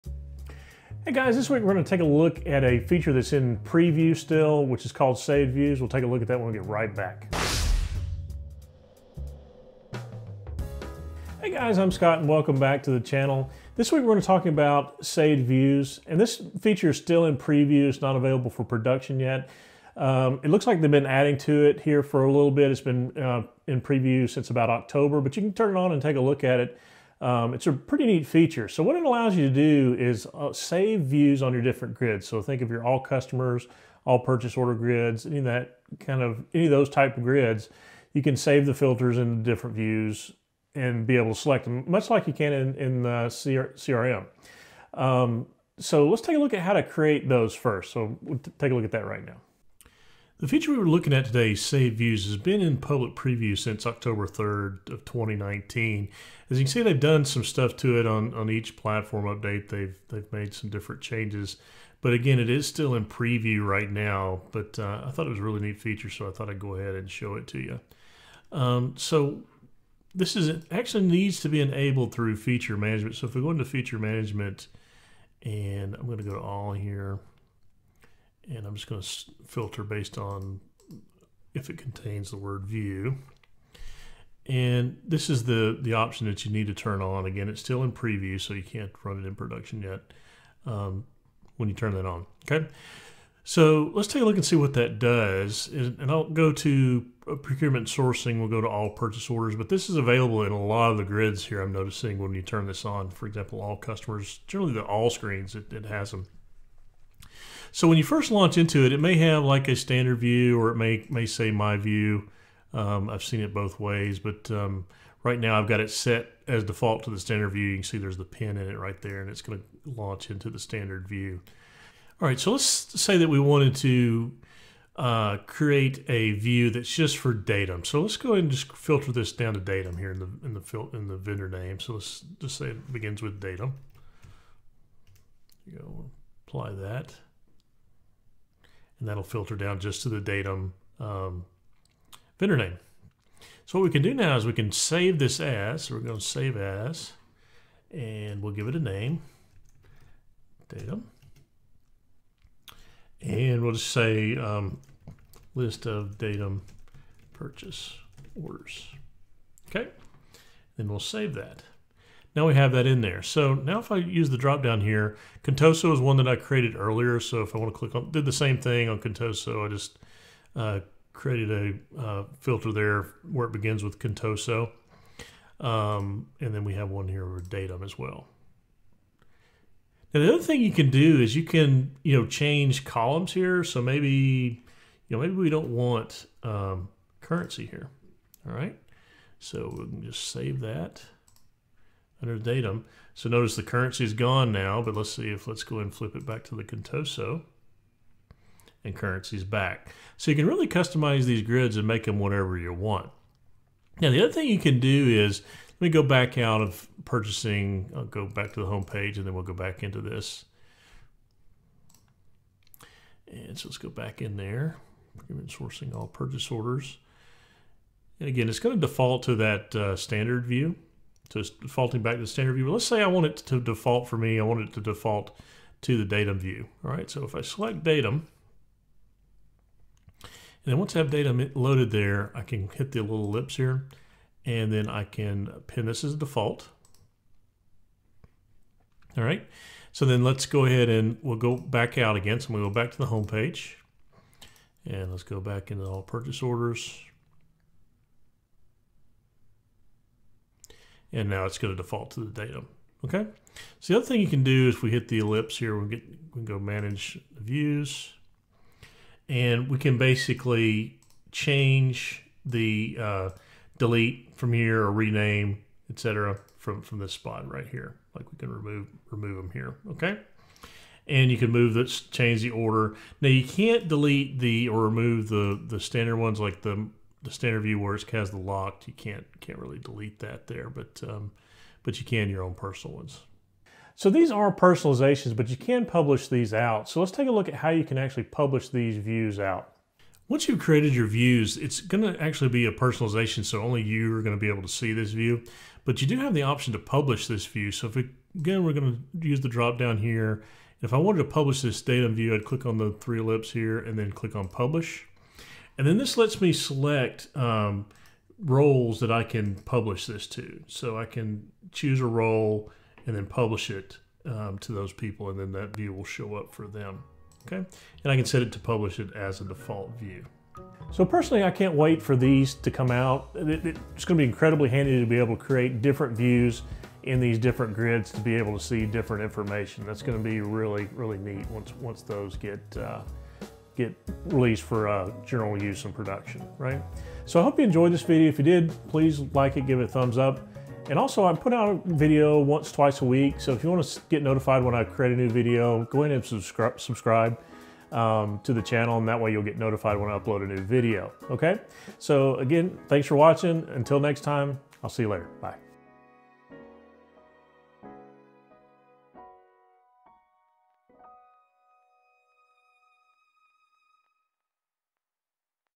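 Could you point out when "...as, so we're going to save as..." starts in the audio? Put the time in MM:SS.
02:25.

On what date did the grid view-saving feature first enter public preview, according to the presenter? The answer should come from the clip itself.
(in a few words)
October 3rd, 2019.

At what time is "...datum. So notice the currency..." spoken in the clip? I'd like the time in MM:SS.
03:12.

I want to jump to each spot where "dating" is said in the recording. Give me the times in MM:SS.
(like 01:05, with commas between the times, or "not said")
not said.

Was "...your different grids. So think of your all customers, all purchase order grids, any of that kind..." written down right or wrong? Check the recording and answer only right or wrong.
right.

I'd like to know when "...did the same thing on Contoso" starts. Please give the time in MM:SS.
02:48.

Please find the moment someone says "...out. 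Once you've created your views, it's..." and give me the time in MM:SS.
04:49.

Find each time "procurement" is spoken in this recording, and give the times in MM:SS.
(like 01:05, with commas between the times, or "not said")
01:37, 03:35.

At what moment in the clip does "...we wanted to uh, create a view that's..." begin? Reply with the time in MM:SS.
02:03.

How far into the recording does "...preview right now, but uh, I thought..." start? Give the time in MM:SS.
01:03.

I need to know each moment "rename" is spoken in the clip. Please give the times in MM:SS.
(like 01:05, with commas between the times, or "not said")
04:24.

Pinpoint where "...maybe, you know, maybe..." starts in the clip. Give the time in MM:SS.
03:03.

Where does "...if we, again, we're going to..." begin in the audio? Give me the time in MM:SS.
04:57.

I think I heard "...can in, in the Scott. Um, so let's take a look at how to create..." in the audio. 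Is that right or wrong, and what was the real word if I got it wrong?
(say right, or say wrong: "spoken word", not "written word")
wrong: "CRM", not "Scott".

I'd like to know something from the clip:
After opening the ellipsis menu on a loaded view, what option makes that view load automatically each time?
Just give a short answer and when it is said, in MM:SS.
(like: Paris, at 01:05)
pin this as default, at 03:55.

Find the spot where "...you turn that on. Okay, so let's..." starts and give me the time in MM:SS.
01:31.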